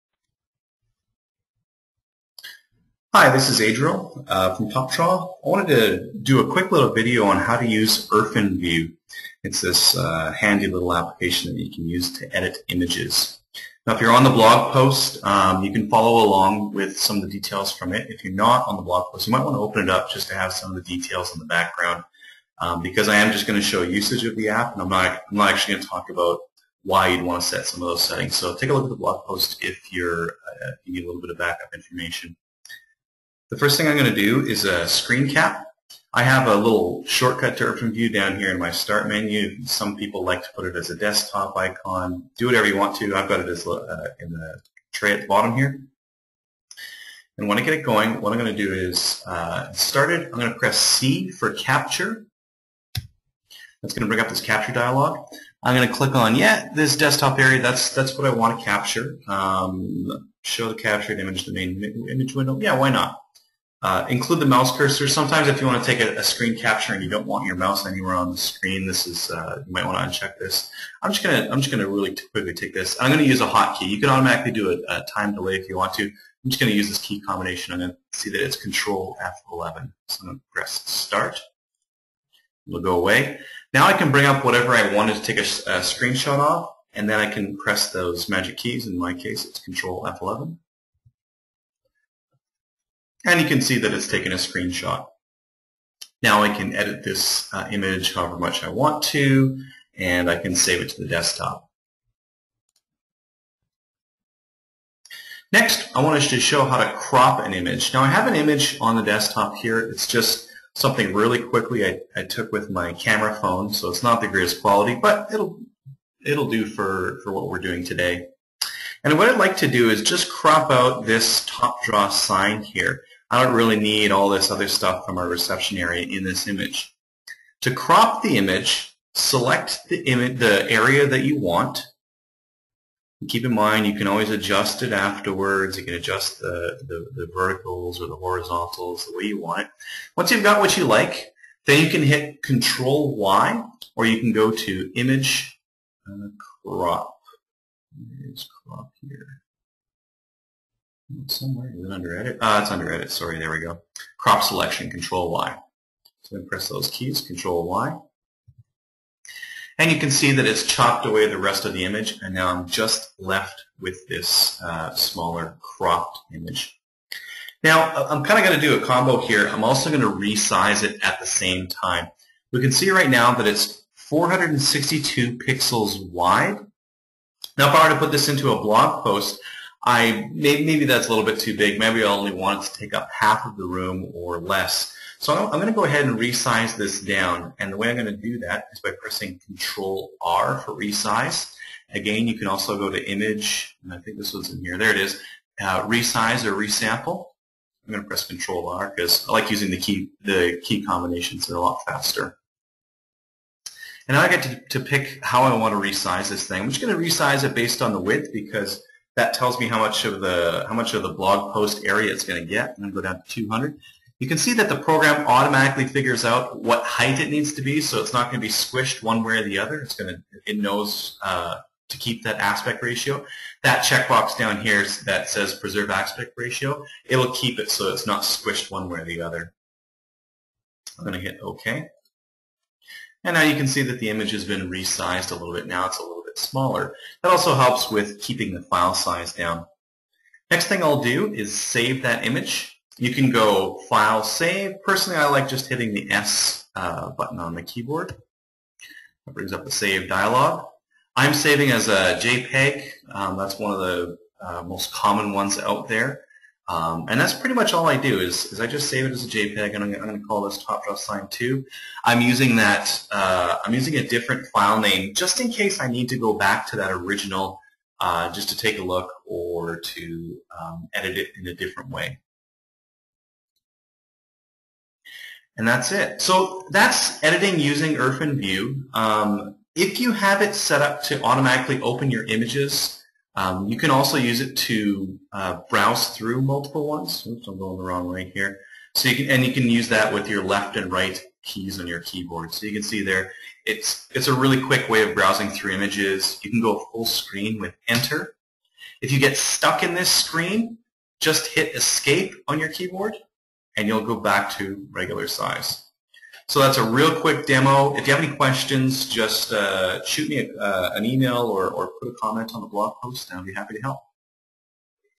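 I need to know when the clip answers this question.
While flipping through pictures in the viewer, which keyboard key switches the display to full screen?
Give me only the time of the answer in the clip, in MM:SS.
04:57.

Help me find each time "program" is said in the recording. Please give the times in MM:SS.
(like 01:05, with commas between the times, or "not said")
03:34.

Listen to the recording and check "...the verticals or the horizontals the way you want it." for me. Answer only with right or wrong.
right.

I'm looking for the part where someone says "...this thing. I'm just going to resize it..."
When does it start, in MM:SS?
03:26.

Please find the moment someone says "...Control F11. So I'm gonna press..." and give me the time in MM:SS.
01:18.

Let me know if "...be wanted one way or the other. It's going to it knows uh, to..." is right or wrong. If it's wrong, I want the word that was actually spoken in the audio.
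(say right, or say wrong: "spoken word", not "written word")
wrong: "squished", not "wanted".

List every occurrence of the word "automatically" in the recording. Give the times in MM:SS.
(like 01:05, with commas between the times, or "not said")
01:14, 03:35, 04:41.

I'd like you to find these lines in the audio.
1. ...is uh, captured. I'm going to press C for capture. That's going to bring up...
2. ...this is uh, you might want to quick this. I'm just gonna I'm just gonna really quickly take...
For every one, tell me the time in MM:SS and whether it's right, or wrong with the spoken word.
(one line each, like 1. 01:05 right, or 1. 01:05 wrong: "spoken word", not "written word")
1. 00:48 wrong: "started", not "captured"
2. 01:08 wrong: "uncheck", not "quick".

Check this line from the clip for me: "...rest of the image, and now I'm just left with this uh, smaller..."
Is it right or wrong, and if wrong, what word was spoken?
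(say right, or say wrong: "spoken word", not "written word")
right.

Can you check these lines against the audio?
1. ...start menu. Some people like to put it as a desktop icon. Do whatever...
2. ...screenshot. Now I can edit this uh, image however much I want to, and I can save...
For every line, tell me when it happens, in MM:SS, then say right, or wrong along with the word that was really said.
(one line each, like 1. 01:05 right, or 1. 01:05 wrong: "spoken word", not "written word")
1. 00:38 right
2. 01:34 right.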